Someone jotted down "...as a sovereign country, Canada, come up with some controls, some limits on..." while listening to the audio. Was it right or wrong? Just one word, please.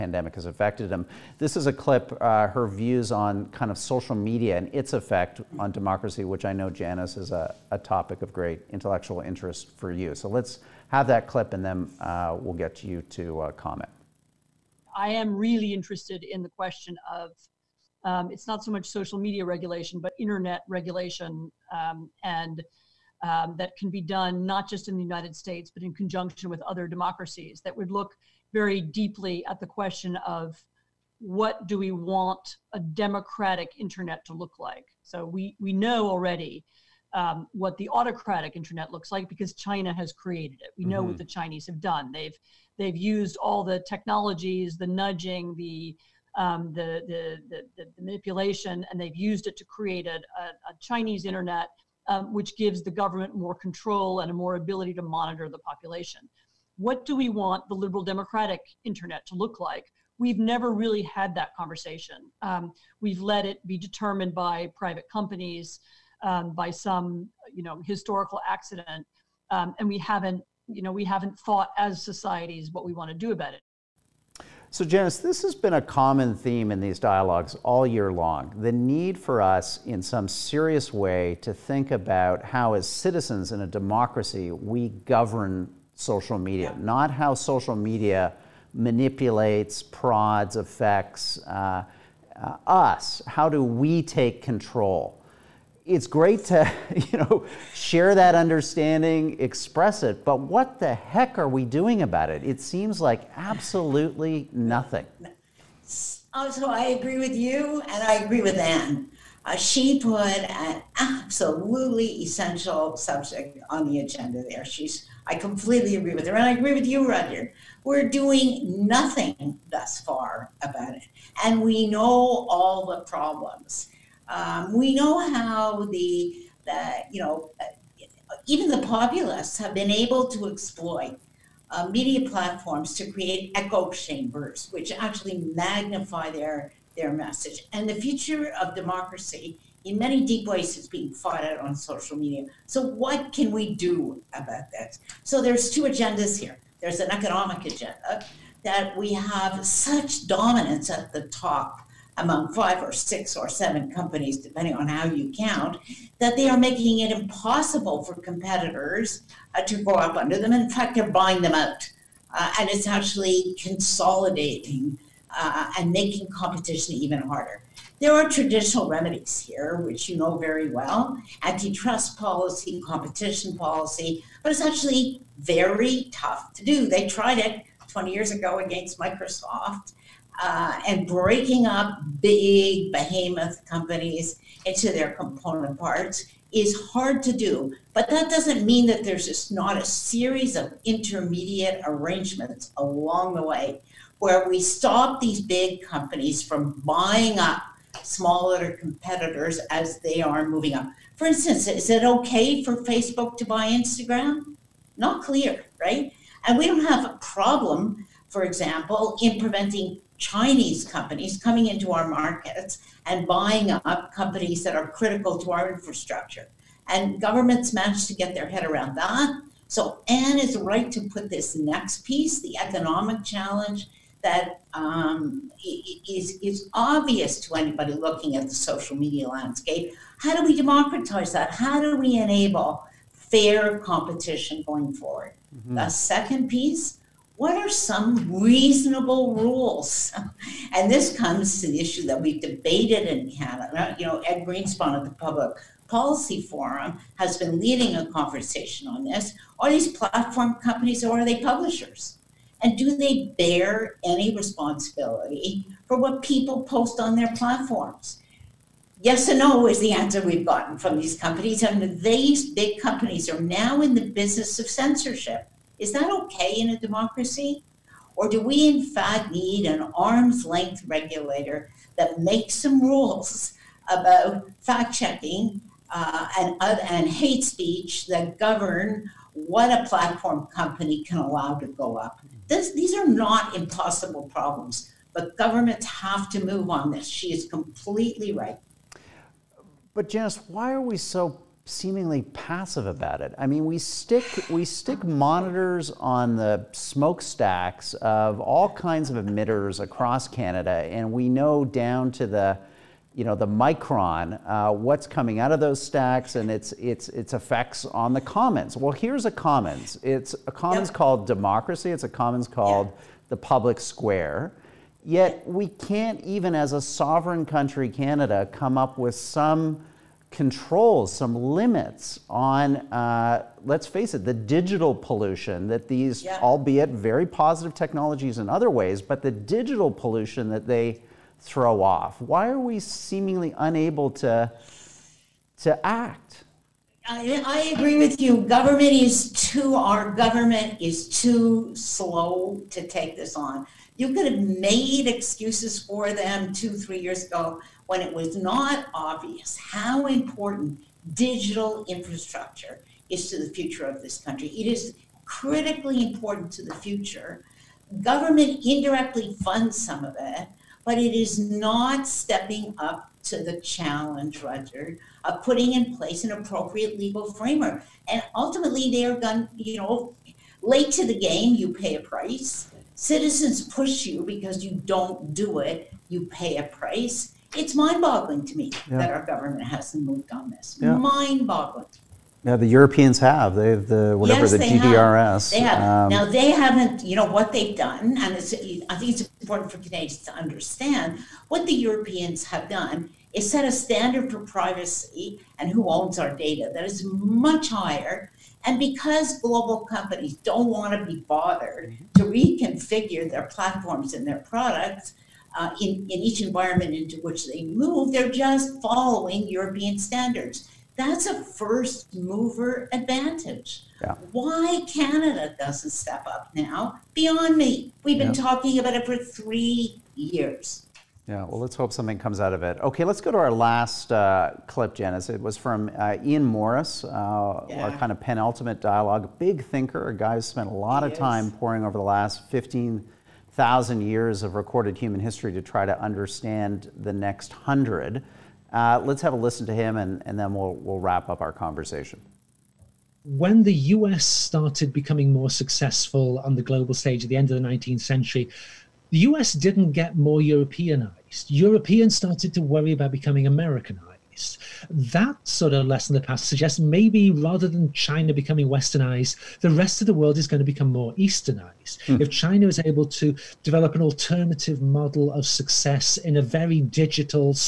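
right.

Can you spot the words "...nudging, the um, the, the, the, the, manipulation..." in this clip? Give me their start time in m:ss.
0:44.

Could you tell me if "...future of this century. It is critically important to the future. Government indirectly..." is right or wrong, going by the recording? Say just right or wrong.
wrong.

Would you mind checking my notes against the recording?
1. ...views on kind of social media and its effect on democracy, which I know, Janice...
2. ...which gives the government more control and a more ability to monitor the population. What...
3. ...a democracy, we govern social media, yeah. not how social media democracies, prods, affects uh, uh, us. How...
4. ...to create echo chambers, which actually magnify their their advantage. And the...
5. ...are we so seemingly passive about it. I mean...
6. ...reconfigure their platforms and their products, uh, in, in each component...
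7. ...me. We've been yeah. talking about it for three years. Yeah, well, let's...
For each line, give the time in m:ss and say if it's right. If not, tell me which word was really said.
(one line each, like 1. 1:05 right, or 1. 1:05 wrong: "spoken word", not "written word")
1. 0:02 right
2. 0:52 right
3. 1:23 wrong: "manipulates", not "democracies"
4. 2:12 wrong: "message", not "advantage"
5. 4:50 right
6. 6:42 wrong: "environment", not "component"
7. 6:57 right.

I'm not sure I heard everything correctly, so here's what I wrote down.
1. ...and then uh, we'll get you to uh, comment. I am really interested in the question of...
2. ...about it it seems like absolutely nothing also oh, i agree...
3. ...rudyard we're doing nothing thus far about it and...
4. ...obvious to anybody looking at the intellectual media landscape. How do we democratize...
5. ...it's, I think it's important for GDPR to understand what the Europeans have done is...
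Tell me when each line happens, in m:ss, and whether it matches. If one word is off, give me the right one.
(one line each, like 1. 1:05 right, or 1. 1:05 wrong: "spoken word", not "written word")
1. 0:11 right
2. 1:42 right
3. 1:57 right
4. 3:46 wrong: "social", not "intellectual"
5. 6:28 wrong: "Canadians", not "GDPR".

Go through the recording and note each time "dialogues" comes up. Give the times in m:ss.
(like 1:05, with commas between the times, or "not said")
1:16, 7:08.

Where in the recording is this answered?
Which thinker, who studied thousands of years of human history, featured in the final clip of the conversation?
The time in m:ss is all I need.
7:06.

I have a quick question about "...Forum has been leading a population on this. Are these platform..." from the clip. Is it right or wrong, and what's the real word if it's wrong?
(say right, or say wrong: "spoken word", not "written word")
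wrong: "conversation", not "population".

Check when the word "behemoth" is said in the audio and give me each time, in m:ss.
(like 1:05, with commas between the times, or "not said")
3:02.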